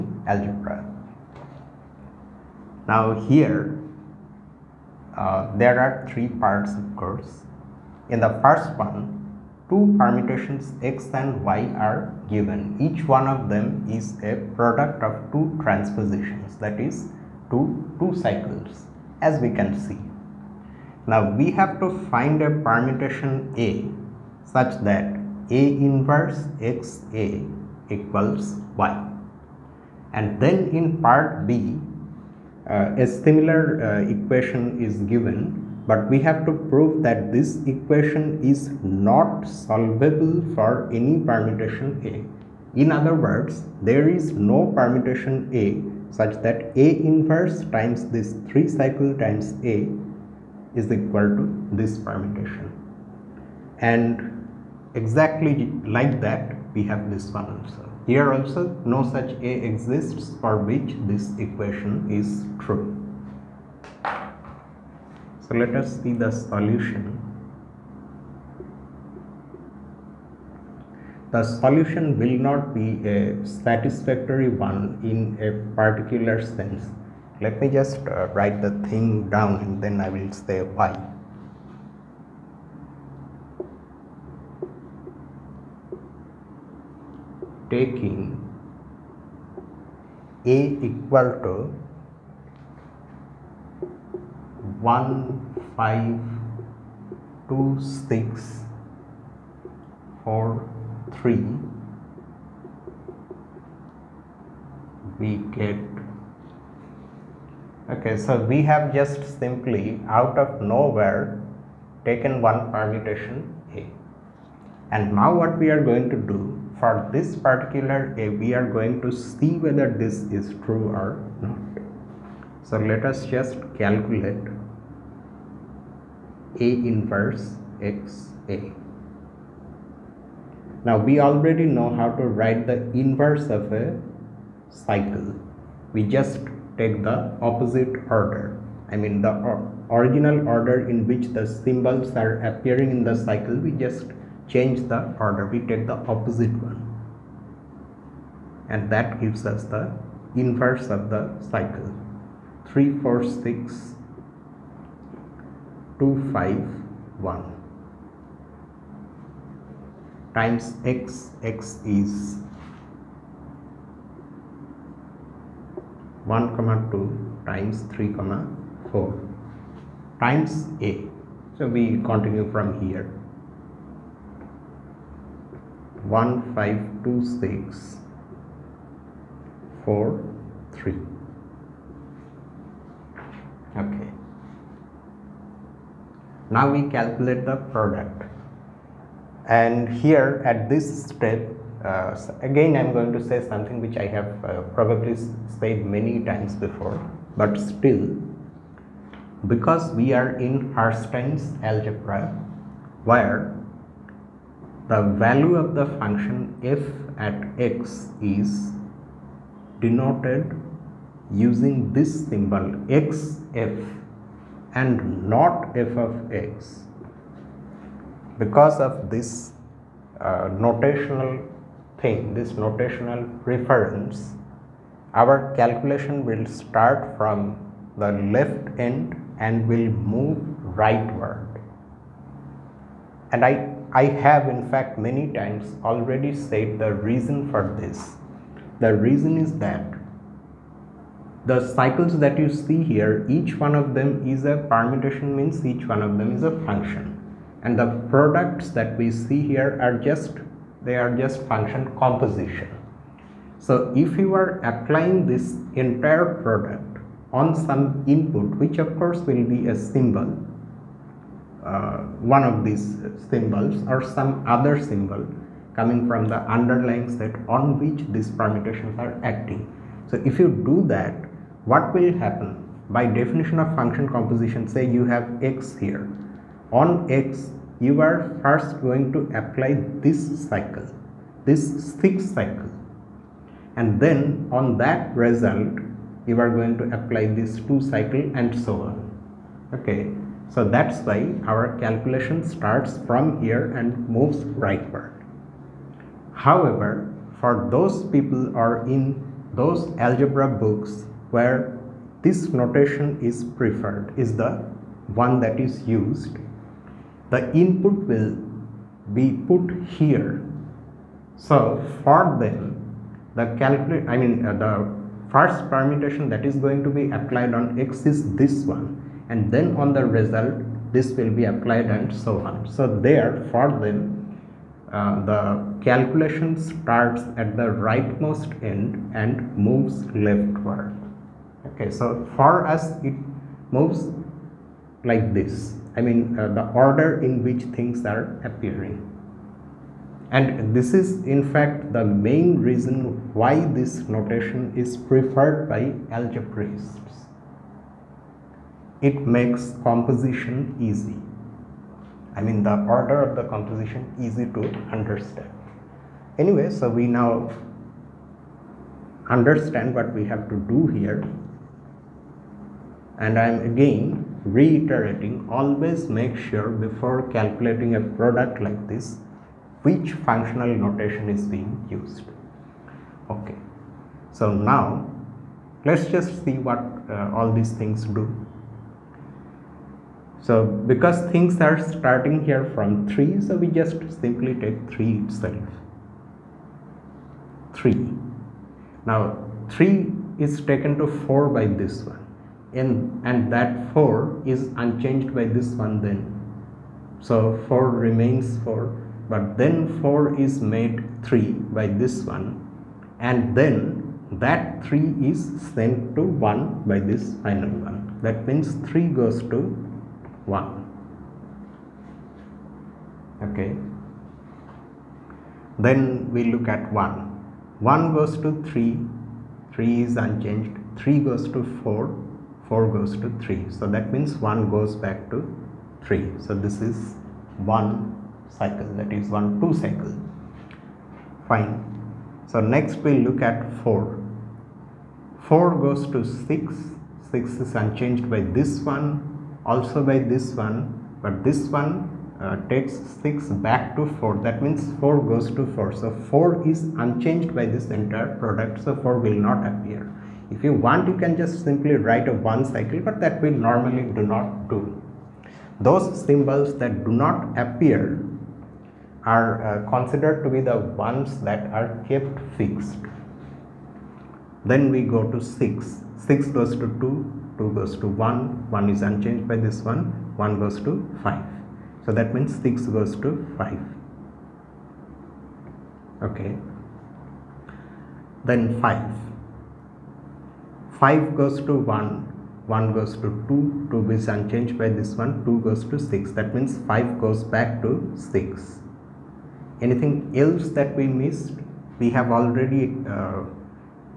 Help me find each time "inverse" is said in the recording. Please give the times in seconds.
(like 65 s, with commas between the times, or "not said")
25 s, 47 s, 126 s, 133 s, 150 s.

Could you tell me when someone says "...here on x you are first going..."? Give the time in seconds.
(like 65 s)
275 s.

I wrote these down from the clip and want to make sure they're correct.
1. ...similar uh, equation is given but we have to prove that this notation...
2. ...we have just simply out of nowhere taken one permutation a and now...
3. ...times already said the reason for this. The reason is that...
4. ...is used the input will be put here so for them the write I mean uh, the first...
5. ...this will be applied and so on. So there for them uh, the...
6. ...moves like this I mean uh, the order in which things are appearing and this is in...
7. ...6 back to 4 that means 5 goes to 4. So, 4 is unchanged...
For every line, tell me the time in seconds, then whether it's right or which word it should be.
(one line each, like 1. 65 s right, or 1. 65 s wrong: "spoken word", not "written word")
1. 33 s wrong: "equation", not "notation"
2. 108 s right
3. 235 s right
4. 305 s wrong: "calculate", not "write"
5. 320 s right
6. 333 s right
7. 443 s wrong: "4", not "5".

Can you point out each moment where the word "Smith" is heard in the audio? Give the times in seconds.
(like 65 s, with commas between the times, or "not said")
not said.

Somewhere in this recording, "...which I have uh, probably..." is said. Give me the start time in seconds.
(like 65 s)
193 s.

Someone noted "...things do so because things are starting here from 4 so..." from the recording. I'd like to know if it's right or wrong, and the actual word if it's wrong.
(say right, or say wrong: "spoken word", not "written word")
wrong: "3", not "4".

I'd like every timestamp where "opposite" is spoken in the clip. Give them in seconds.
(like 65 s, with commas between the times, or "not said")
137 s, 146 s.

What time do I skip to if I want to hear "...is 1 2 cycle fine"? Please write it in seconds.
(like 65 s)
429 s.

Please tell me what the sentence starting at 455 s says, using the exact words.
Those symbols that do not appear are uh, considered to be the ones that are kept fixed.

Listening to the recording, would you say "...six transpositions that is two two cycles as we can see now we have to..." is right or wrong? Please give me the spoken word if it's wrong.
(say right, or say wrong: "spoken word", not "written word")
wrong: "two", not "six".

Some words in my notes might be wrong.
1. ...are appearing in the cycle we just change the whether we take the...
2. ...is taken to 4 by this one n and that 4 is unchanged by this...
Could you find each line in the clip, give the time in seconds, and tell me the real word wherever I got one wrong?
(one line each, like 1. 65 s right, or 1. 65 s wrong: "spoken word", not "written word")
1. 142 s wrong: "order", not "whether"
2. 390 s right.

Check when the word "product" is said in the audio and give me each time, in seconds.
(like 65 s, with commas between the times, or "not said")
14 s, 187 s, 248 s, 256 s, 367 s, 448 s.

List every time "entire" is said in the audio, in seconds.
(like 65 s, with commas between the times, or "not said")
255 s, 447 s.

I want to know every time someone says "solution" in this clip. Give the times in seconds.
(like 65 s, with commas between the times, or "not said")
66 s, 71 s.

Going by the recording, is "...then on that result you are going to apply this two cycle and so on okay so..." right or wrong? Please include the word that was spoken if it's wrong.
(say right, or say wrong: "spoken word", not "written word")
right.